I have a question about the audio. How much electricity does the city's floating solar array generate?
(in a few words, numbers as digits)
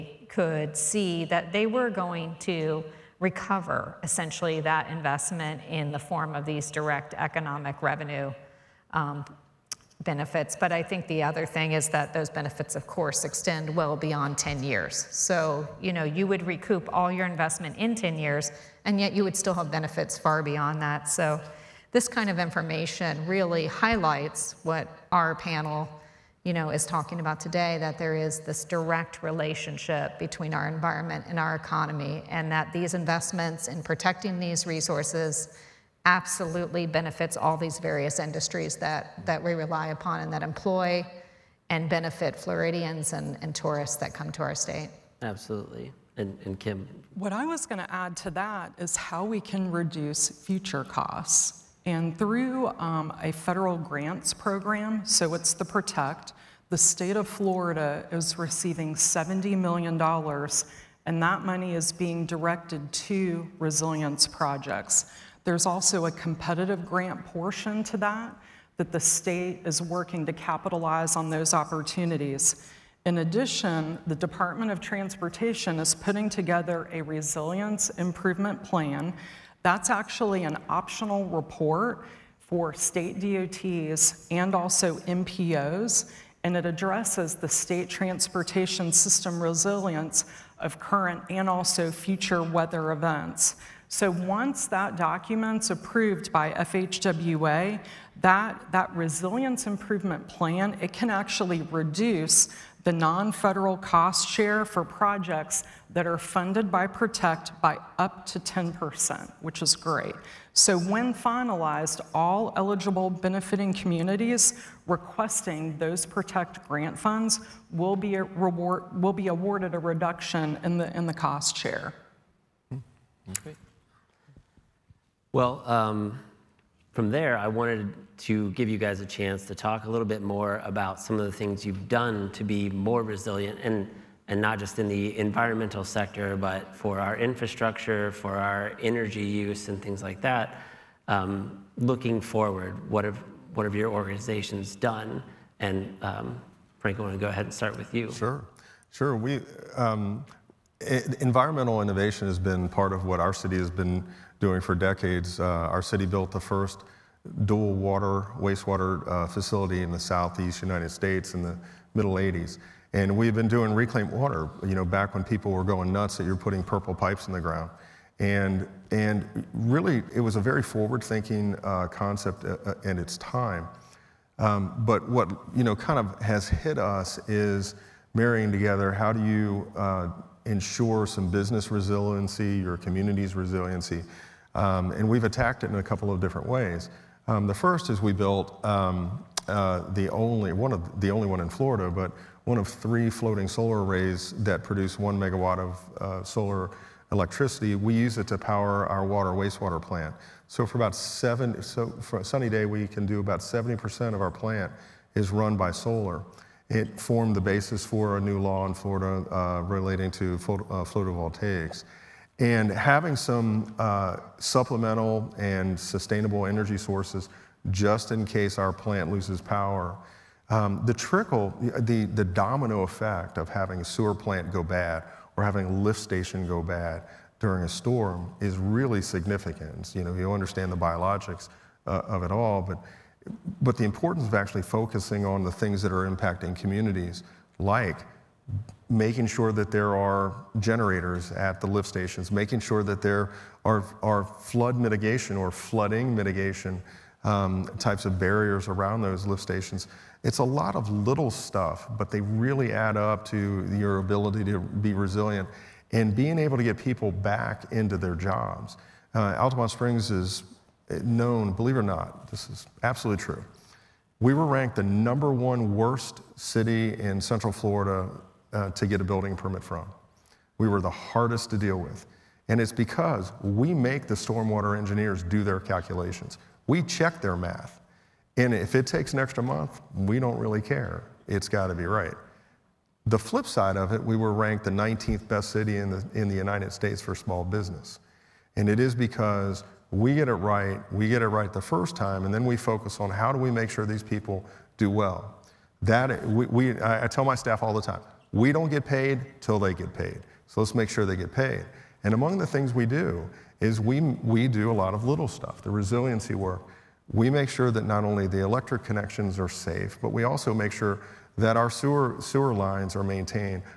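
1 megawatt.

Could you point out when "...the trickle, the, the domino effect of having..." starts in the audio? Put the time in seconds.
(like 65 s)
220 s.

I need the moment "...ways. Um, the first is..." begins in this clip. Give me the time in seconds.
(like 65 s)
186 s.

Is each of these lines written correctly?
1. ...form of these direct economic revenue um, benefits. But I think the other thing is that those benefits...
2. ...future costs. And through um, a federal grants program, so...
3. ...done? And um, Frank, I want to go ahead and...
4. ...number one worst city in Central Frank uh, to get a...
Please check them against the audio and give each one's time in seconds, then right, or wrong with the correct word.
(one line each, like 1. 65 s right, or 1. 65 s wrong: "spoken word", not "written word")
1. 5 s right
2. 50 s right
3. 144 s right
4. 264 s wrong: "Florida", not "Frank".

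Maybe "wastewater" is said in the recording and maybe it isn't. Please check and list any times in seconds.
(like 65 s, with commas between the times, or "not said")
158 s, 199 s.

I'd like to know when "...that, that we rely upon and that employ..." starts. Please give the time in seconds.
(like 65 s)
38 s.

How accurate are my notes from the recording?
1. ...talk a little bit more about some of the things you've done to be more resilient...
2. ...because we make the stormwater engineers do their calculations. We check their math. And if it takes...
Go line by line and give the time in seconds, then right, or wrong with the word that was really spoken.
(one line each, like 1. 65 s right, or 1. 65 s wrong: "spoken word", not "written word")
1. 129 s right
2. 272 s right.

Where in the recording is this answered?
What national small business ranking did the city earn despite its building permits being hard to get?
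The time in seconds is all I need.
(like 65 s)
284 s.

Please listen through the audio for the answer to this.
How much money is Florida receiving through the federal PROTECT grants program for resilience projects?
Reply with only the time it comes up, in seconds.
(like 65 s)
58 s.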